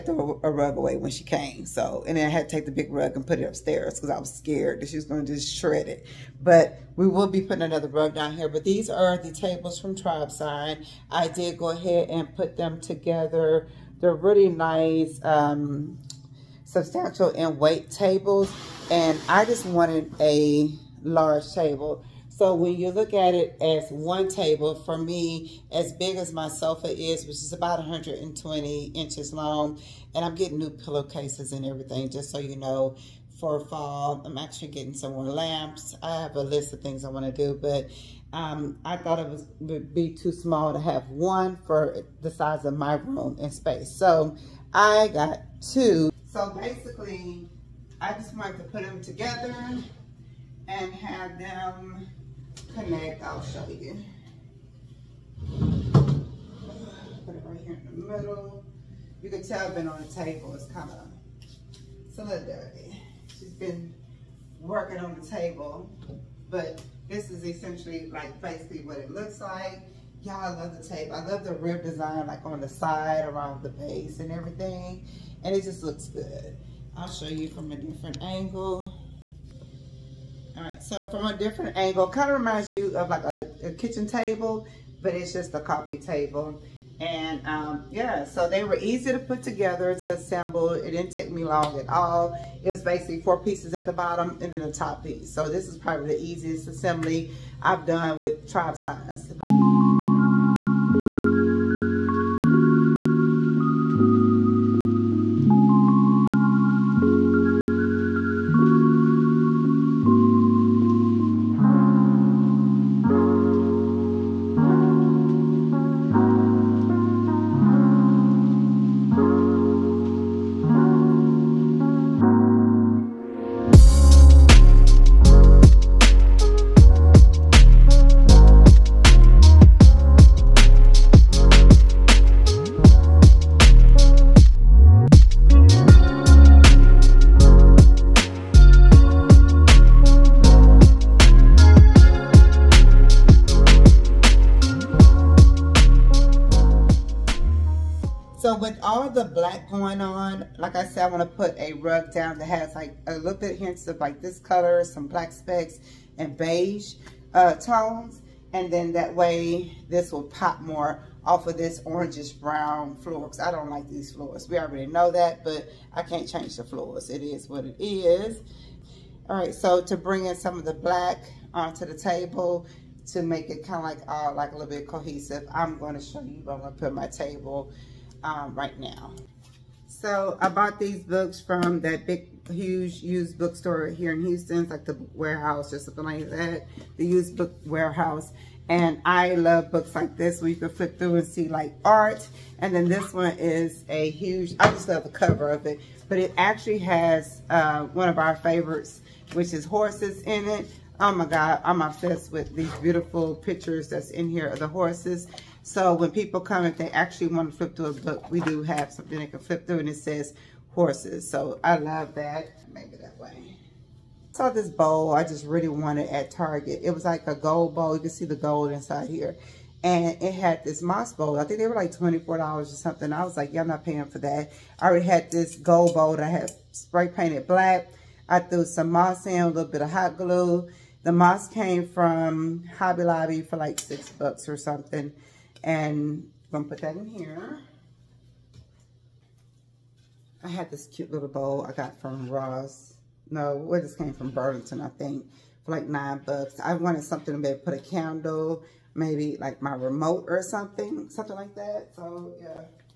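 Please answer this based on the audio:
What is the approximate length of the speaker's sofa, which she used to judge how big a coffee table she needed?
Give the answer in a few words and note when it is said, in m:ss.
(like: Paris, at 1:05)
120 inches, at 0:27.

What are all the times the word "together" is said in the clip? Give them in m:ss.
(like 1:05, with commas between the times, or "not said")
0:12, 0:49, 1:29.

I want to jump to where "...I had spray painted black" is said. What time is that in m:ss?
3:46.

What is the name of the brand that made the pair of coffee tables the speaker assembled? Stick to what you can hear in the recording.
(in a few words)
Tribe Sign.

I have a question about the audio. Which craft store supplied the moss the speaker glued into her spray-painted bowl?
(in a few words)
Hobby Lobby.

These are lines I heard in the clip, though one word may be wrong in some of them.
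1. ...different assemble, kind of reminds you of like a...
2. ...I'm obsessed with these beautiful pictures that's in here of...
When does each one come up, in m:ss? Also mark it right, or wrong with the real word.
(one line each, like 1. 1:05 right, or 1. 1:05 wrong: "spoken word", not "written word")
1. 1:21 wrong: "angle", not "assemble"
2. 3:21 right.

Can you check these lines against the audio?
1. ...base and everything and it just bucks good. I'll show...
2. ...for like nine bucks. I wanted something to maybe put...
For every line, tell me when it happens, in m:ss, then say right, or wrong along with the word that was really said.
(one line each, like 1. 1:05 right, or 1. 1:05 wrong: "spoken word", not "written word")
1. 1:13 wrong: "looks", not "bucks"
2. 4:05 right.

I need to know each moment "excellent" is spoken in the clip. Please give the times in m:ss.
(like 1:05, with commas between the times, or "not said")
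not said.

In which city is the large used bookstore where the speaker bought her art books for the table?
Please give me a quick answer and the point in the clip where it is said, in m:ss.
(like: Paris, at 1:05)
Houston, at 3:04.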